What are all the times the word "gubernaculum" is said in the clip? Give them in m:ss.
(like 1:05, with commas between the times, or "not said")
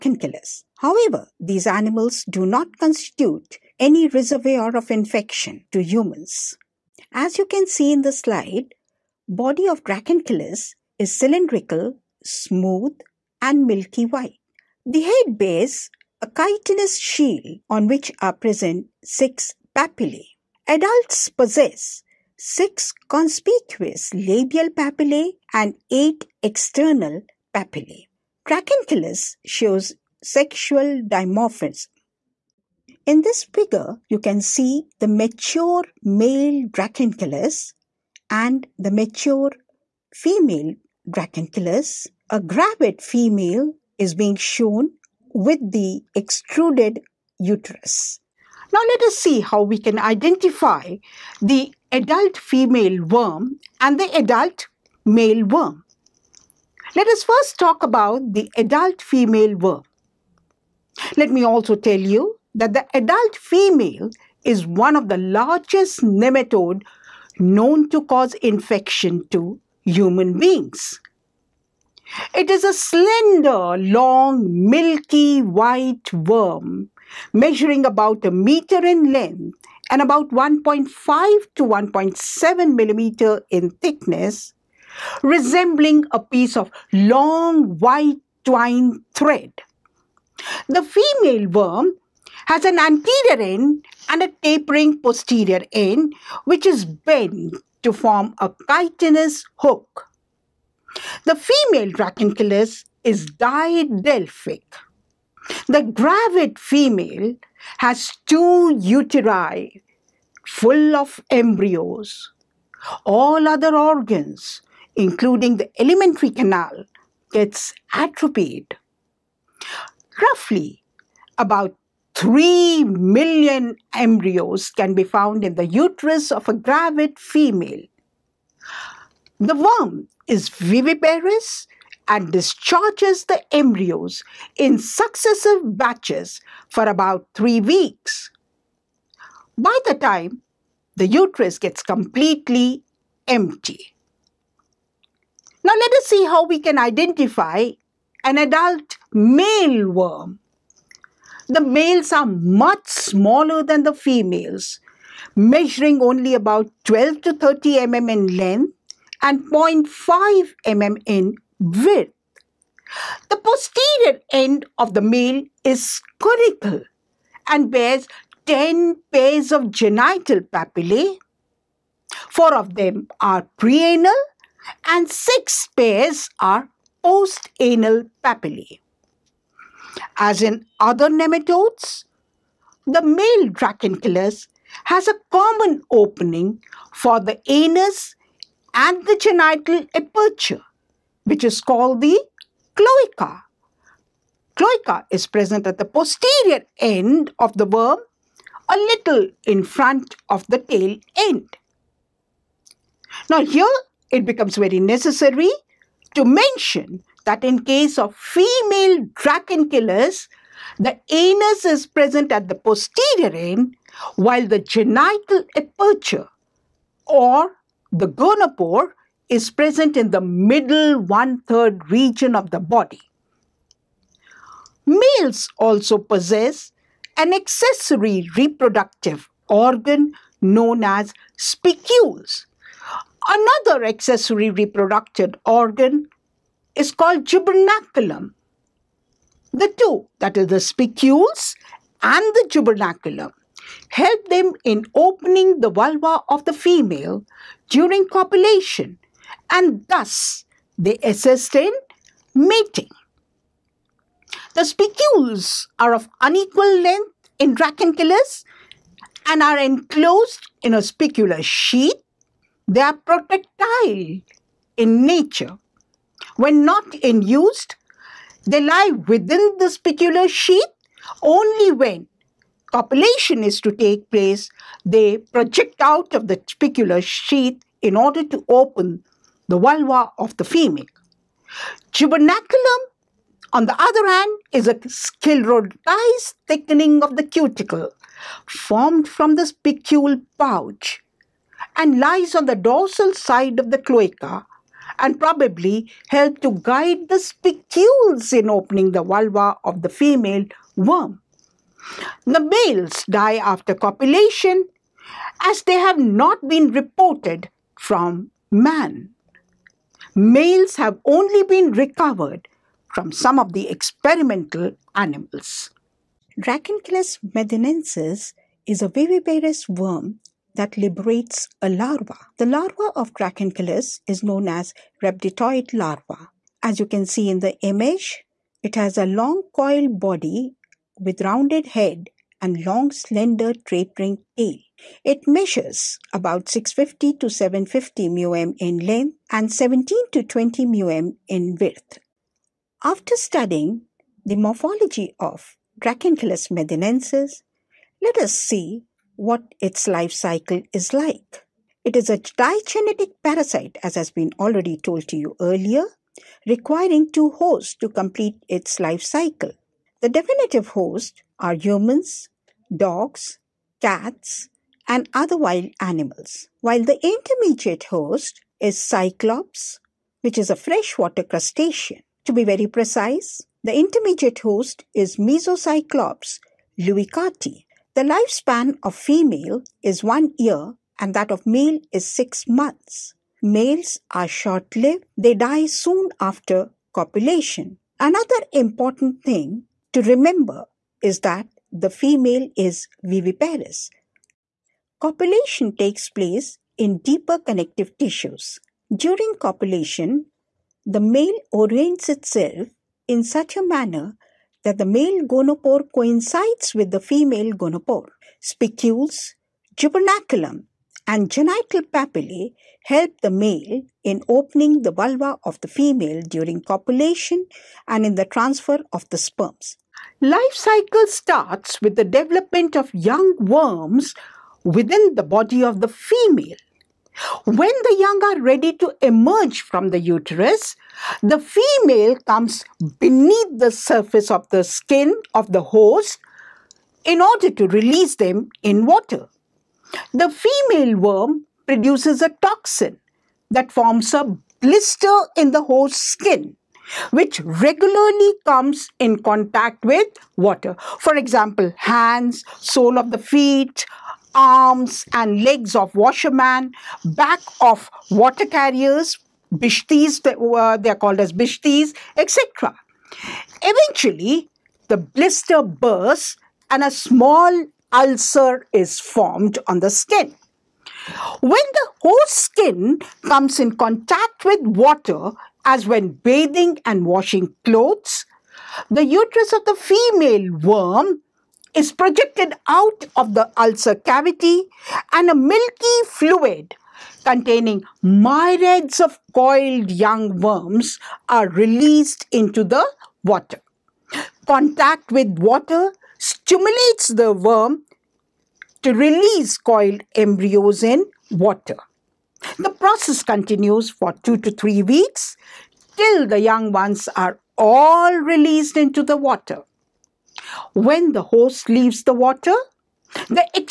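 3:57, 4:02, 4:41, 6:49.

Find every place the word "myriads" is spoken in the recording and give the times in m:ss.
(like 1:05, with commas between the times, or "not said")
8:08.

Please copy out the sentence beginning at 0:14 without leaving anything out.
The head bears a chitinous shield on which are present six papillae.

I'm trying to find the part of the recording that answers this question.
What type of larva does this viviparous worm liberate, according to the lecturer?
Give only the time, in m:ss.
5:25.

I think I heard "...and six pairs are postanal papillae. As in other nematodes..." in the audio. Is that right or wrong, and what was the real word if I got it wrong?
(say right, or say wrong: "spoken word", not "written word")
right.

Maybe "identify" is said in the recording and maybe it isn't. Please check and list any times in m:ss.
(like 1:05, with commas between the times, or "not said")
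0:49, 2:26.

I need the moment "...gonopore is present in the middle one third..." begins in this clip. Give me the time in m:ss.
3:38.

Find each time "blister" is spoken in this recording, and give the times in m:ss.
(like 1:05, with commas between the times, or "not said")
7:24, 7:44.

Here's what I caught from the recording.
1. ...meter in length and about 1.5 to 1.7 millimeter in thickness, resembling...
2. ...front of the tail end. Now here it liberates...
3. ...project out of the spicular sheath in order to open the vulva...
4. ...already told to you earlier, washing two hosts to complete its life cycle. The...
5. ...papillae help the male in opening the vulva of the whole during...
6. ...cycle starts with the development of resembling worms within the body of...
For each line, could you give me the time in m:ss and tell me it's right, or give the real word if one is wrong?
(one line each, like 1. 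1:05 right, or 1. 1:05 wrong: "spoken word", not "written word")
1. 1:18 right
2. 3:19 wrong: "becomes", not "liberates"
3. 4:35 right
4. 5:54 wrong: "requiring", not "washing"
5. 6:51 wrong: "female", not "whole"
6. 7:00 wrong: "young", not "resembling".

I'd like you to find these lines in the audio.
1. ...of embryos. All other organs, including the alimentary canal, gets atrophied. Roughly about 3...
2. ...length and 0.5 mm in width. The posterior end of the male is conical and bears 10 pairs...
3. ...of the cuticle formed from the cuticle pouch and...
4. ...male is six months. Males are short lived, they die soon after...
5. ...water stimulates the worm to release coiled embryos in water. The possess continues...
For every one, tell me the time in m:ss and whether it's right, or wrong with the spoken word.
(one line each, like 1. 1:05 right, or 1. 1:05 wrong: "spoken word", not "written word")
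1. 1:50 right
2. 2:38 right
3. 4:47 wrong: "spicule", not "cuticle"
4. 6:21 right
5. 8:15 wrong: "process", not "possess".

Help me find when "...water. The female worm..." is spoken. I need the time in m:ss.
7:18.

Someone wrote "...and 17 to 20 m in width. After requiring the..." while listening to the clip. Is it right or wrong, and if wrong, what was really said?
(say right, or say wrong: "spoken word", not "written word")
wrong: "studying", not "requiring".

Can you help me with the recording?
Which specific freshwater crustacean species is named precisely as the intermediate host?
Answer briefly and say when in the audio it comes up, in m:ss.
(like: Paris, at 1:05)
Mesocyclops leuckarti, at 6:15.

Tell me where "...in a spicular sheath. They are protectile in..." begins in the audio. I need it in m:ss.
4:20.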